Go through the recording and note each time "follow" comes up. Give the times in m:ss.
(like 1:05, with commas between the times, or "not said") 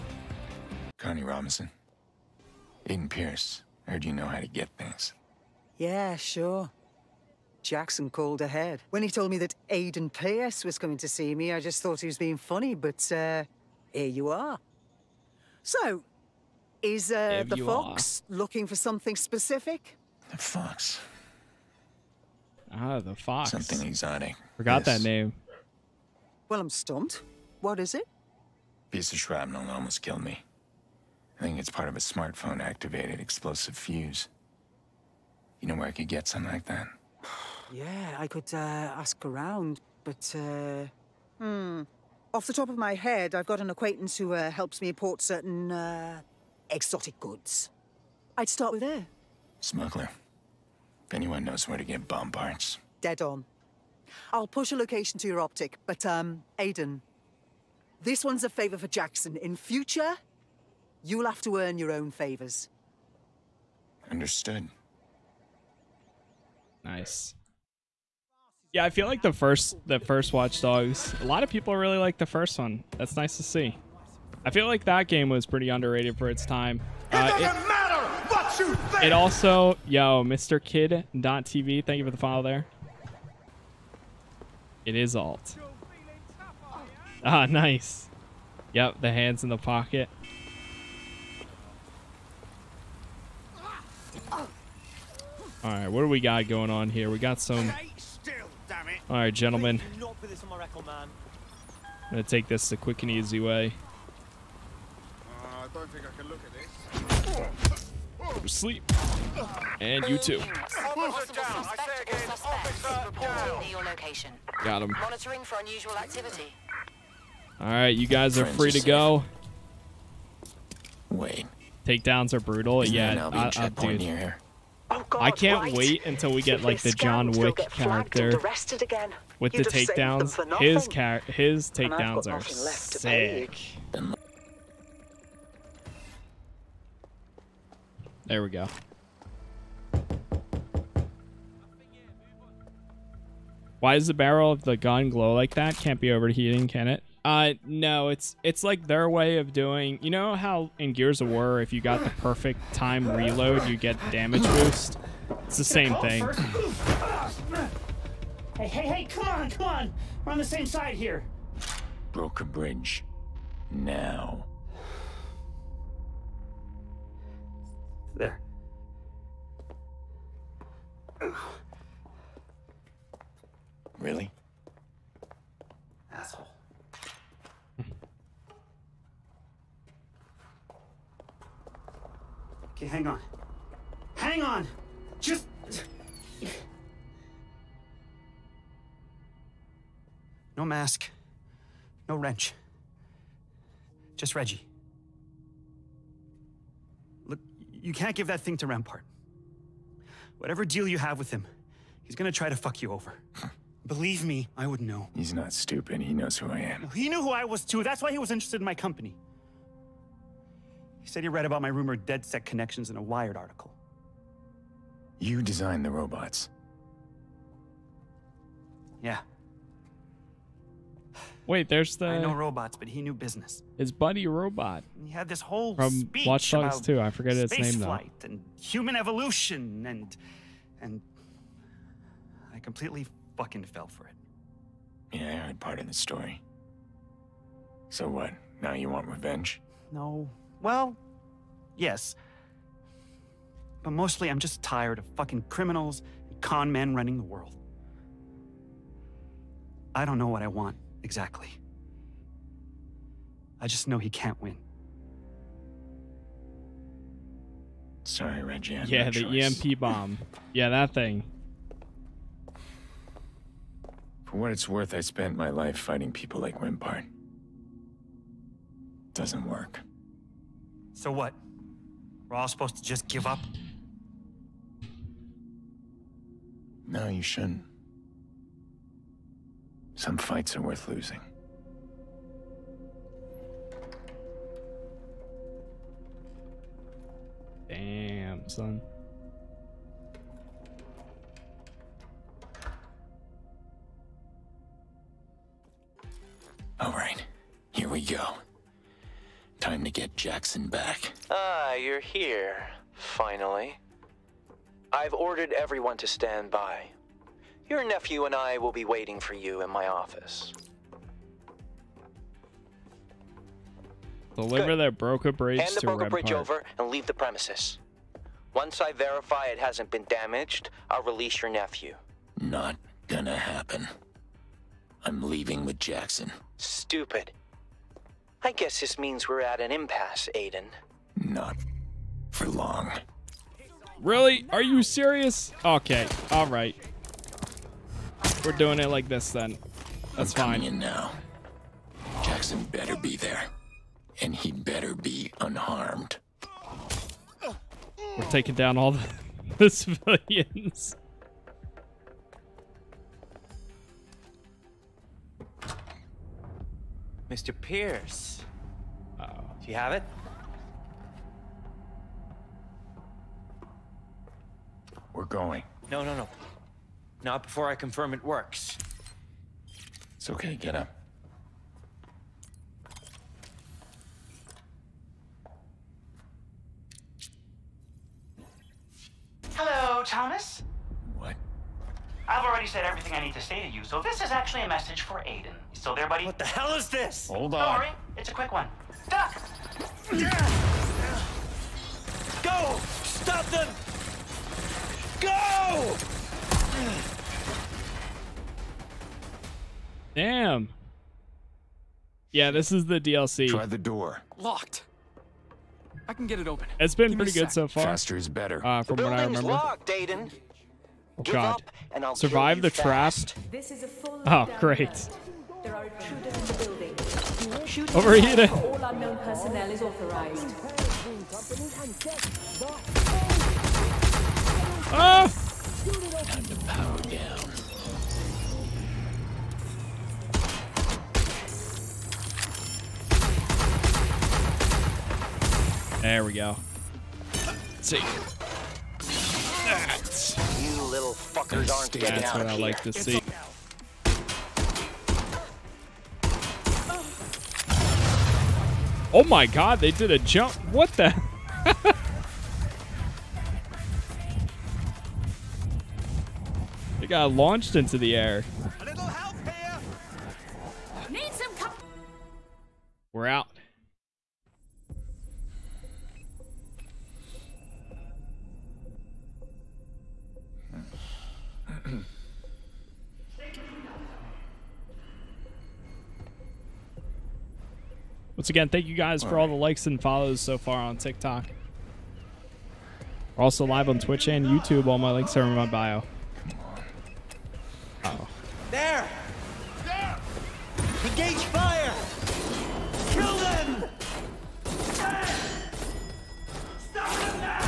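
1:22, 8:00.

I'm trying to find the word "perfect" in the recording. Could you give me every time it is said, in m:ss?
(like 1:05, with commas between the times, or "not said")
2:32.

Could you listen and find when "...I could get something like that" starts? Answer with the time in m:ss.
0:35.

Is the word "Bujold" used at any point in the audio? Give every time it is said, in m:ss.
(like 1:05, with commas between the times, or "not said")
not said.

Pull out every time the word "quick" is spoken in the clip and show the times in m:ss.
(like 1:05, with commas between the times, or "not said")
1:42, 6:28.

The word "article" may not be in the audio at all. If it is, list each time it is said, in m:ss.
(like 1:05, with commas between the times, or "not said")
3:33.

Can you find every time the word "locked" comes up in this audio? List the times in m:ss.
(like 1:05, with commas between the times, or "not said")
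6:44, 6:49.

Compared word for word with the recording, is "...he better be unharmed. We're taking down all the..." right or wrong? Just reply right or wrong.
right.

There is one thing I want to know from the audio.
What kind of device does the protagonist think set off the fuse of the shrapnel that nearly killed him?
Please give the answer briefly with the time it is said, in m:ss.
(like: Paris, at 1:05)
smartphone, at 0:32.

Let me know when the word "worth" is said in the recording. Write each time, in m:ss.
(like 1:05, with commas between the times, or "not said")
4:24, 4:40.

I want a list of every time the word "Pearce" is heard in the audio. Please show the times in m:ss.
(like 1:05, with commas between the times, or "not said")
0:03, 0:10, 5:57.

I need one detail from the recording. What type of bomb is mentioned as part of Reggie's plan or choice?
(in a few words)
EMP bomb.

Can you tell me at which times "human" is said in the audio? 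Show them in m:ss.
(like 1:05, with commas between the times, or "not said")
3:48.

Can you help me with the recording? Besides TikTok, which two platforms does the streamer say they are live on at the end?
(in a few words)
Twitch and YouTube.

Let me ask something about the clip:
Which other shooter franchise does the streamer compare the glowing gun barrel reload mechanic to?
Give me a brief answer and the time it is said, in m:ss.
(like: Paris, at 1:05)
Gears of War, at 2:30.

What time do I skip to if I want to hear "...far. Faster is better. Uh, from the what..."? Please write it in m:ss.
6:47.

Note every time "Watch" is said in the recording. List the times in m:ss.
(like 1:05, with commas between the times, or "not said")
1:10, 3:46.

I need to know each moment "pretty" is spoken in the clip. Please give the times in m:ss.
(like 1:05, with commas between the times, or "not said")
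1:15, 6:47.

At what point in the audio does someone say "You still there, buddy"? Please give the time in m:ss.
6:25.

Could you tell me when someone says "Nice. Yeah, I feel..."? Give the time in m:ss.
1:06.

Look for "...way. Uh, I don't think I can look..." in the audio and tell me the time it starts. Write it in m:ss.
1:43.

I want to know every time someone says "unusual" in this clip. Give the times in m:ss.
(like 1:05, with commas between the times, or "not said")
1:55.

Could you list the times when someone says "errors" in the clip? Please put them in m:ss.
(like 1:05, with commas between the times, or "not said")
not said.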